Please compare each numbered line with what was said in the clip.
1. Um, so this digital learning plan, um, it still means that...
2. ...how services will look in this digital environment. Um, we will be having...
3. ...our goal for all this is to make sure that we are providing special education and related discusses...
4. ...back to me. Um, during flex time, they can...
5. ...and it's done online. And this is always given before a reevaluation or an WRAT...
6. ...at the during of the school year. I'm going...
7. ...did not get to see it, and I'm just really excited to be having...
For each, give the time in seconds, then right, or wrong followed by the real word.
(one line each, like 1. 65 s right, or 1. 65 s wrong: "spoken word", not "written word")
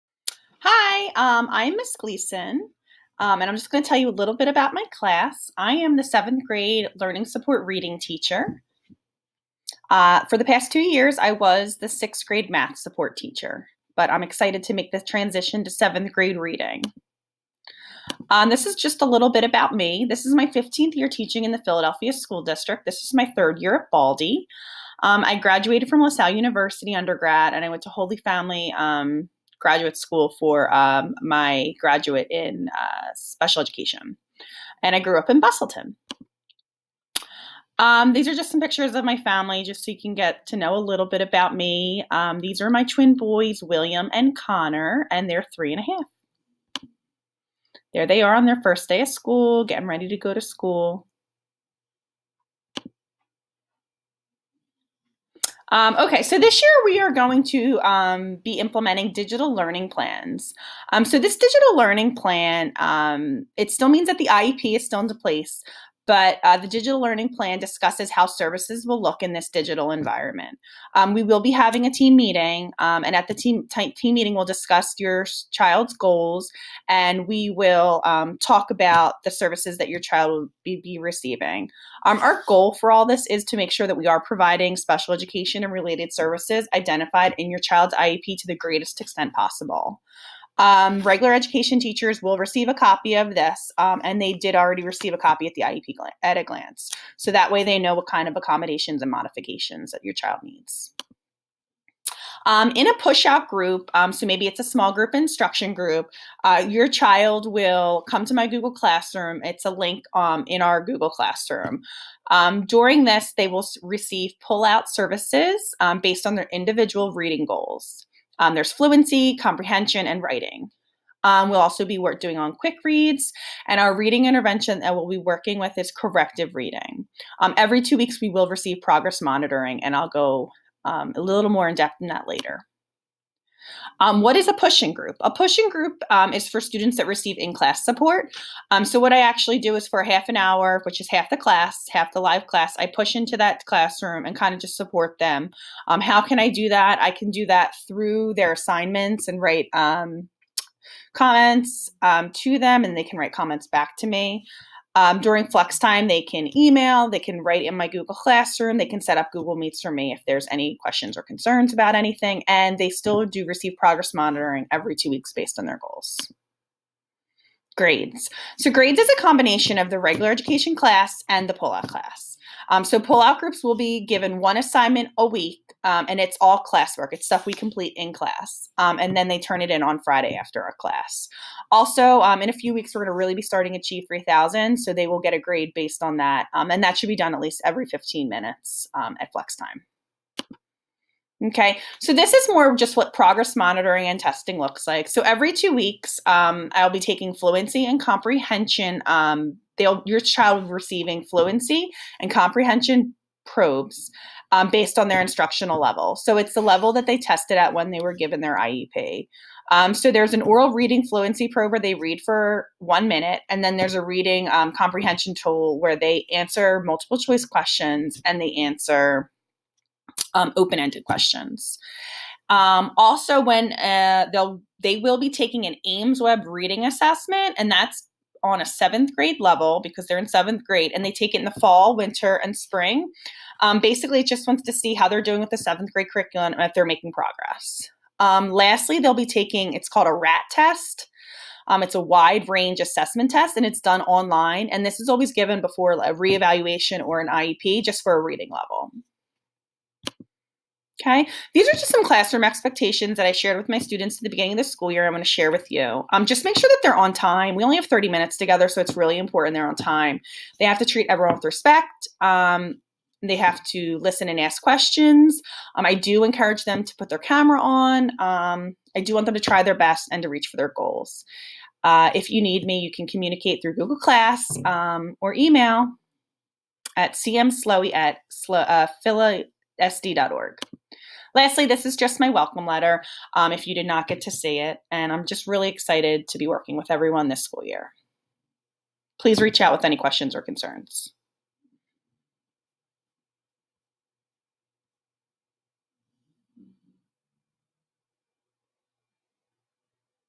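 1. 60 s right
2. 68 s right
3. 82 s wrong: "services", not "discusses"
4. 153 s right
5. 243 s wrong: "IEP", not "WRAT"
6. 254 s wrong: "beginning", not "during"
7. 283 s wrong: "working", not "having".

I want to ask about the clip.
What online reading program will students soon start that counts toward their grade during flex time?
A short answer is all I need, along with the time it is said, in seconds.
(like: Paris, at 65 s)
Achieve 3000, at 183 s.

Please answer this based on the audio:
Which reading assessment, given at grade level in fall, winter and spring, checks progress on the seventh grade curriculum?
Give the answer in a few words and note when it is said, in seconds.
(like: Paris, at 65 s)
AIMSweb, at 225 s.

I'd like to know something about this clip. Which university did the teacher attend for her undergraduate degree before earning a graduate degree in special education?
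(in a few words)
LaSalle University.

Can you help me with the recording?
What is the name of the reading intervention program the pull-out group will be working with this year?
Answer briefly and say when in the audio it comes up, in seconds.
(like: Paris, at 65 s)
Corrective Reading, at 125 s.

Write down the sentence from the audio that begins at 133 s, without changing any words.
Um, what is a pushing group?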